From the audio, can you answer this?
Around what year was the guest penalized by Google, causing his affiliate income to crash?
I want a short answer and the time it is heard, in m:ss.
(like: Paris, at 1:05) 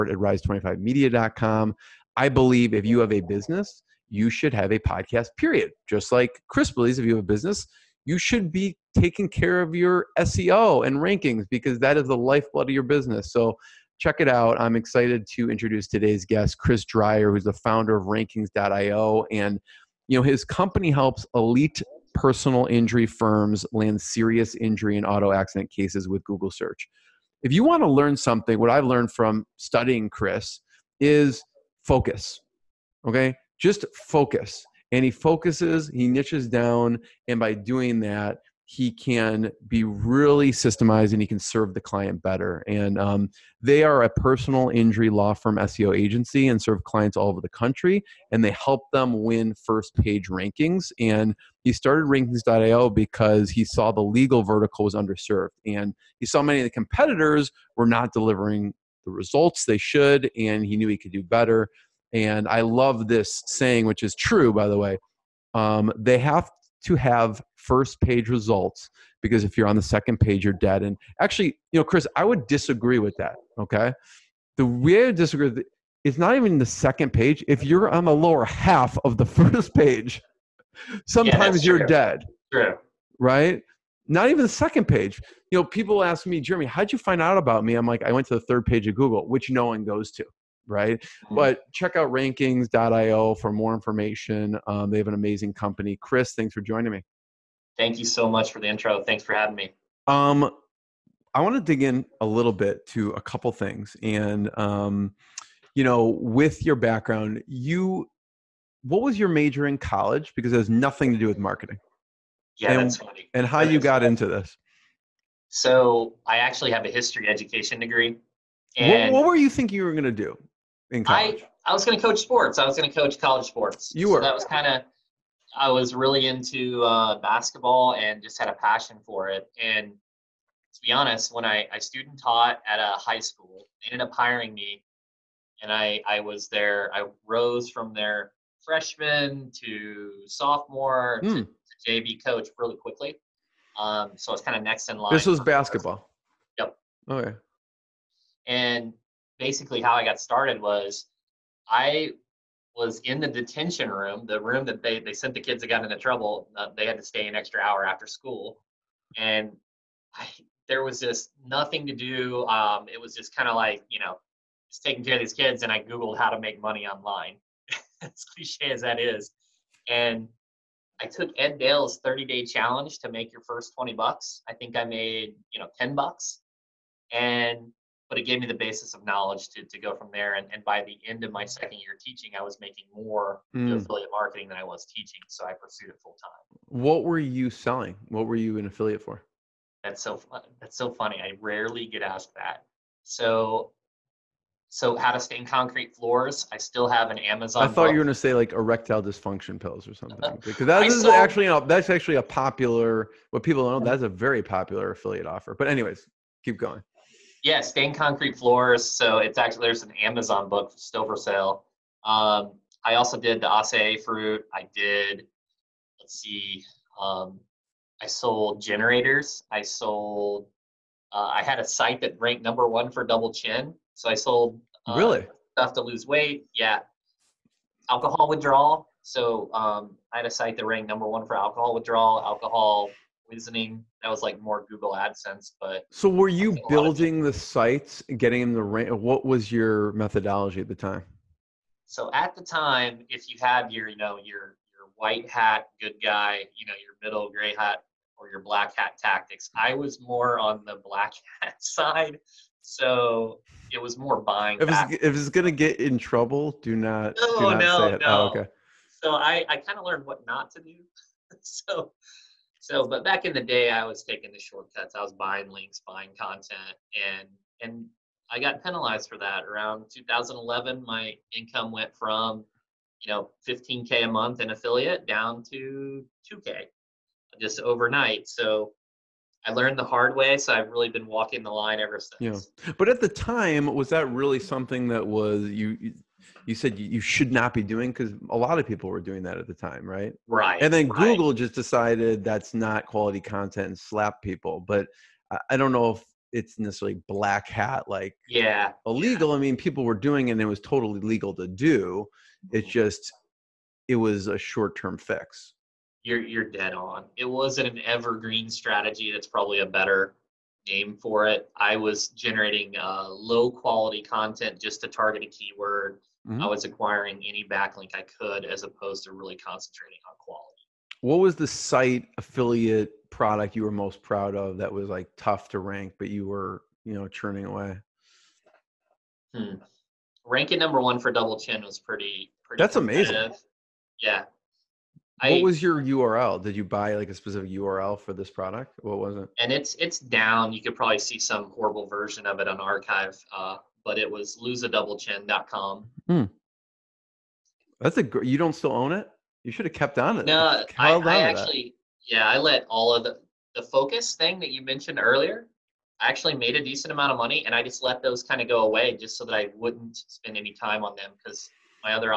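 2011, at 4:29.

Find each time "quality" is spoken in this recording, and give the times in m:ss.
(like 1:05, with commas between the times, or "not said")
4:52, 5:13, 5:20.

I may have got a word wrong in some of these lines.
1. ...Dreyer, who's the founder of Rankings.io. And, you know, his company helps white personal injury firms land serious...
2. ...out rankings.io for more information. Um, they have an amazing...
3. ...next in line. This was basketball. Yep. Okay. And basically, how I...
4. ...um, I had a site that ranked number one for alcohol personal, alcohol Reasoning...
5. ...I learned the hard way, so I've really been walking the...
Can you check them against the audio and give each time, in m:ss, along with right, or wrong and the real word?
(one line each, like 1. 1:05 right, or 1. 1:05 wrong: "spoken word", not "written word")
1. 0:16 wrong: "elite", not "white"
2. 1:31 right
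3. 2:24 right
4. 3:49 wrong: "withdrawal", not "personal"
5. 4:39 right.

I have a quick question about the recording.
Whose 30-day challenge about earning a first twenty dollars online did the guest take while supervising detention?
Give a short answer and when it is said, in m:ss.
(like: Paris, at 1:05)
Ed Dale, at 2:51.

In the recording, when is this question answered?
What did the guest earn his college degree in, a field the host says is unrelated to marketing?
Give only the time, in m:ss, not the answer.
1:56.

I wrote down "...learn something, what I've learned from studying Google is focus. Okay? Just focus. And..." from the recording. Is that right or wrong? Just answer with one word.
wrong.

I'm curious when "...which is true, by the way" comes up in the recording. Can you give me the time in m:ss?
1:03.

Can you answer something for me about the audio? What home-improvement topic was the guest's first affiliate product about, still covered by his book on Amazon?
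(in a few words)
Stain concrete floors.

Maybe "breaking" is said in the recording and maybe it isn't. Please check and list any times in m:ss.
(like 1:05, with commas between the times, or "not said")
not said.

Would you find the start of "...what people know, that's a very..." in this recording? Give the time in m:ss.
3:23.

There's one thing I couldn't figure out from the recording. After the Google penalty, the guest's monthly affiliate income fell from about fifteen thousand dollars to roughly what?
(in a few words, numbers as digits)
$2k.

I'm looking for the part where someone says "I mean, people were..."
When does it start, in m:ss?
4:59.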